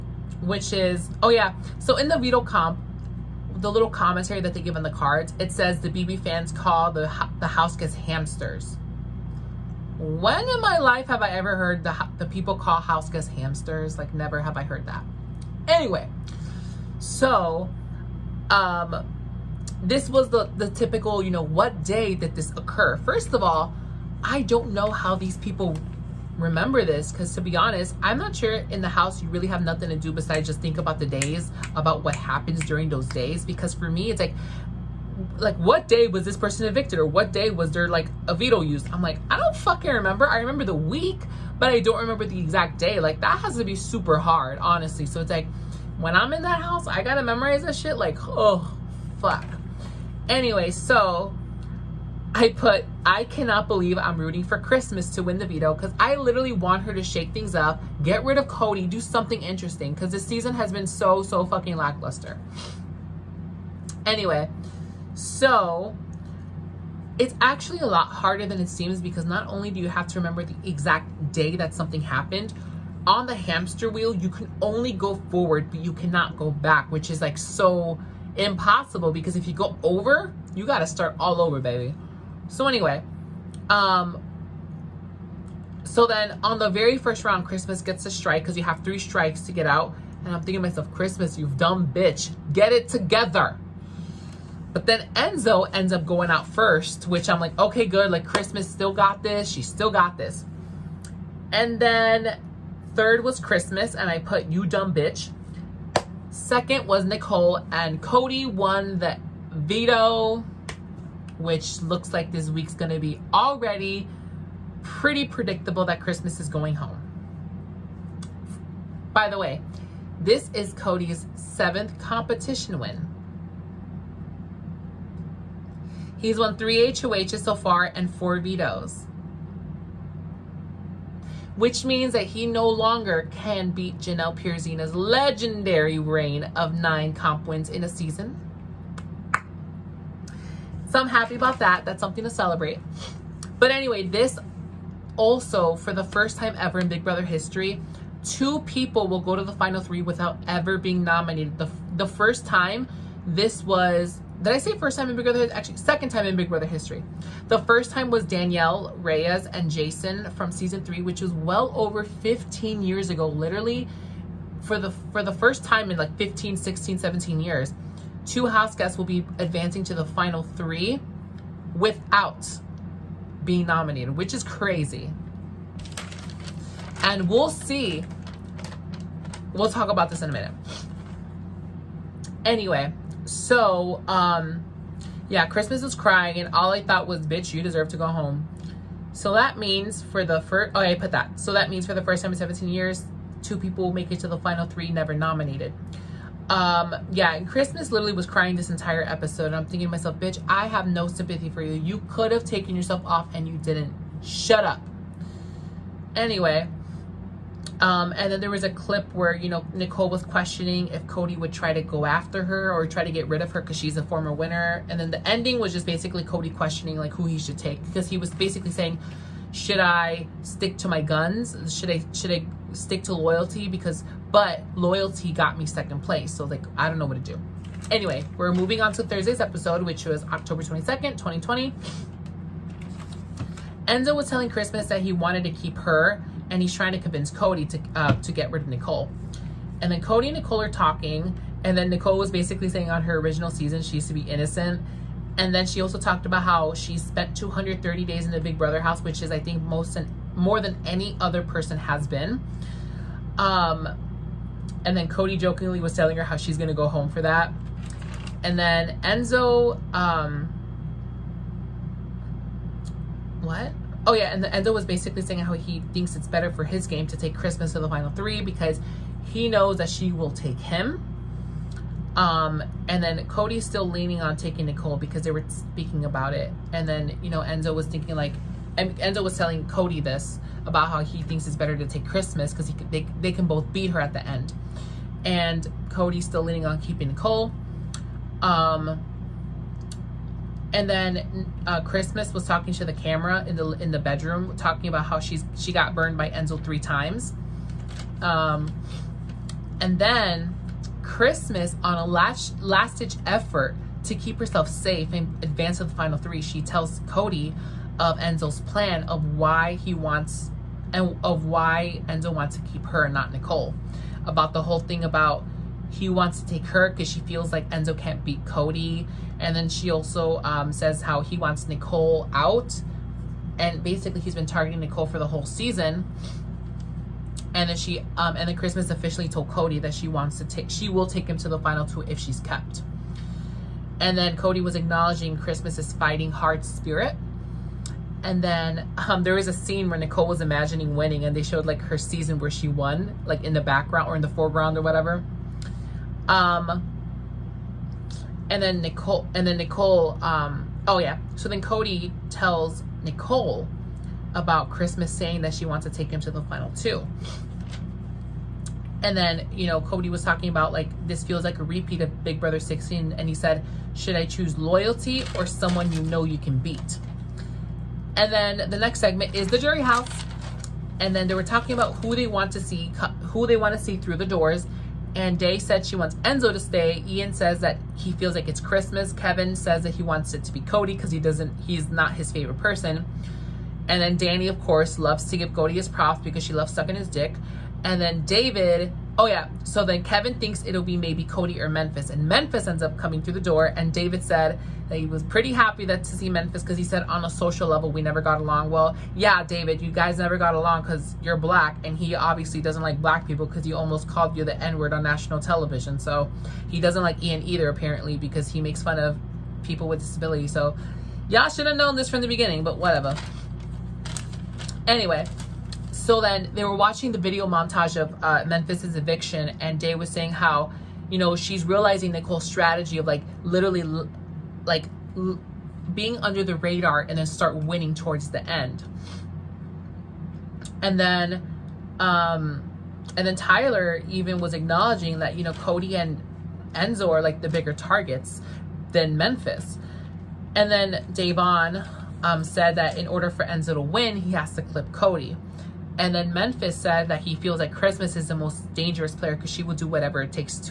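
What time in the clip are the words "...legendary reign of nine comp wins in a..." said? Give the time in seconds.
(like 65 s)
134 s.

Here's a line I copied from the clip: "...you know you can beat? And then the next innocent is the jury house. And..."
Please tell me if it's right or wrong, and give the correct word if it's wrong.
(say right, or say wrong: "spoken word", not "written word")
wrong: "segment", not "innocent".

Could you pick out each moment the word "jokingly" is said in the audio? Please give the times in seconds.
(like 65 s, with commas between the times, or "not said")
255 s.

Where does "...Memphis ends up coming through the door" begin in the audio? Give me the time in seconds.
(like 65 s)
392 s.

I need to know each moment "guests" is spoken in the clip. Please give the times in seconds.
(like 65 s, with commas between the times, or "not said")
13 s, 168 s.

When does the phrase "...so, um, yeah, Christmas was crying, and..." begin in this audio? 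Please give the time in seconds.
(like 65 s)
183 s.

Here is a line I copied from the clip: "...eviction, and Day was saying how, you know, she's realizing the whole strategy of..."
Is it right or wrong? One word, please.
right.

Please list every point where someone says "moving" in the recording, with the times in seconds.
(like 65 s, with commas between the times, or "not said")
228 s.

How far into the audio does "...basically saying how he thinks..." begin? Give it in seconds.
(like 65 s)
264 s.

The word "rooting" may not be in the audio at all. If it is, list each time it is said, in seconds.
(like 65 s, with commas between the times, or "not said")
54 s.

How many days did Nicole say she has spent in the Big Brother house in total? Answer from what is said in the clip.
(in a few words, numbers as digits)
230.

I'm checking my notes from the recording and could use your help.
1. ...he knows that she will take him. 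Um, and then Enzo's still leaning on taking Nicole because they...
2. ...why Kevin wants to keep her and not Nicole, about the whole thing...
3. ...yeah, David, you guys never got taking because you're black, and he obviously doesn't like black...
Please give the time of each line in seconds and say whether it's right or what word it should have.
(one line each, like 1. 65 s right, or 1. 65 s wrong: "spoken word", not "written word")
1. 269 s wrong: "Cody", not "Enzo"
2. 311 s wrong: "Enzo", not "Kevin"
3. 399 s wrong: "along", not "taking".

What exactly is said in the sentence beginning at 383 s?
And then Dani, of course, loves to give Cody his props because she loves sucking his dick.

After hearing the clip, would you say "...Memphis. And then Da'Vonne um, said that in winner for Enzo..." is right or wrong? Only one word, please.
wrong.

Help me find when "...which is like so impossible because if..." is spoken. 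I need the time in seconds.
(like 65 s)
76 s.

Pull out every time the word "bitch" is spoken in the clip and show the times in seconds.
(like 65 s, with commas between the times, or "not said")
91 s, 104 s, 187 s, 200 s.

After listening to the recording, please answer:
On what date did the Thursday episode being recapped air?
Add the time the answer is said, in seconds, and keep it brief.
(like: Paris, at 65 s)
October 22, 2020, at 230 s.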